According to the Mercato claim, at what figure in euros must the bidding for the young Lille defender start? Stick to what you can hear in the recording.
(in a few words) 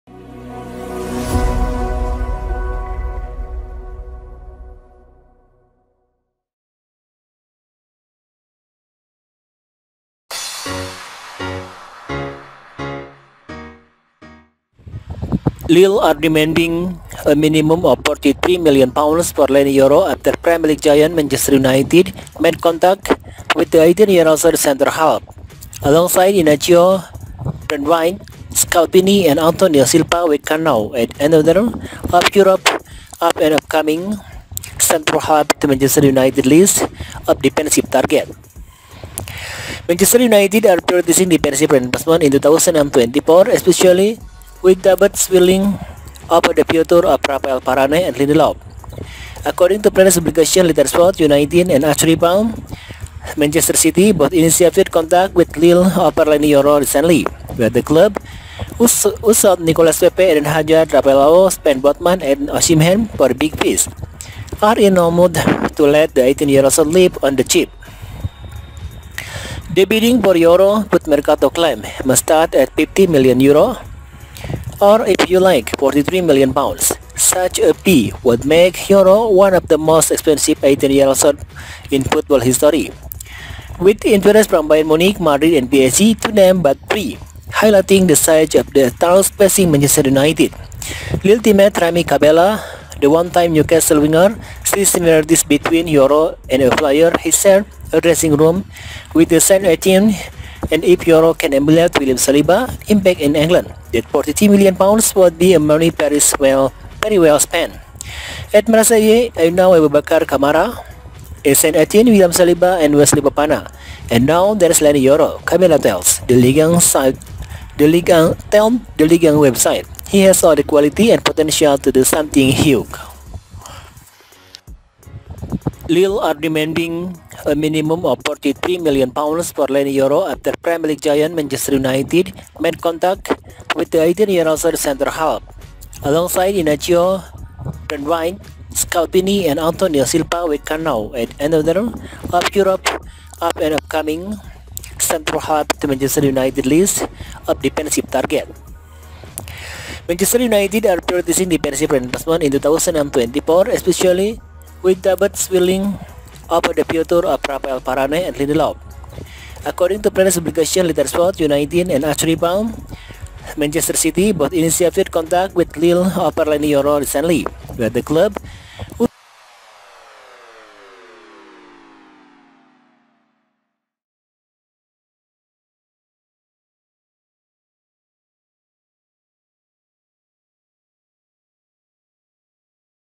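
50 million euros.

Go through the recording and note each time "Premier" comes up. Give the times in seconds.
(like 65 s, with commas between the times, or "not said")
20 s, 130 s.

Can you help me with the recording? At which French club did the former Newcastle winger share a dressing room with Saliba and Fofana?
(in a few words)
Marseille.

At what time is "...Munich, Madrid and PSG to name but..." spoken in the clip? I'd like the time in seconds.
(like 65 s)
84 s.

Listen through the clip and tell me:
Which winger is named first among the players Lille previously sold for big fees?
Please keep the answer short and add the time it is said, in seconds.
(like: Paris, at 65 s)
Nicolas Pepe, at 59 s.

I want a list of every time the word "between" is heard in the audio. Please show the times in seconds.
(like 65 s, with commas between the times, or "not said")
95 s.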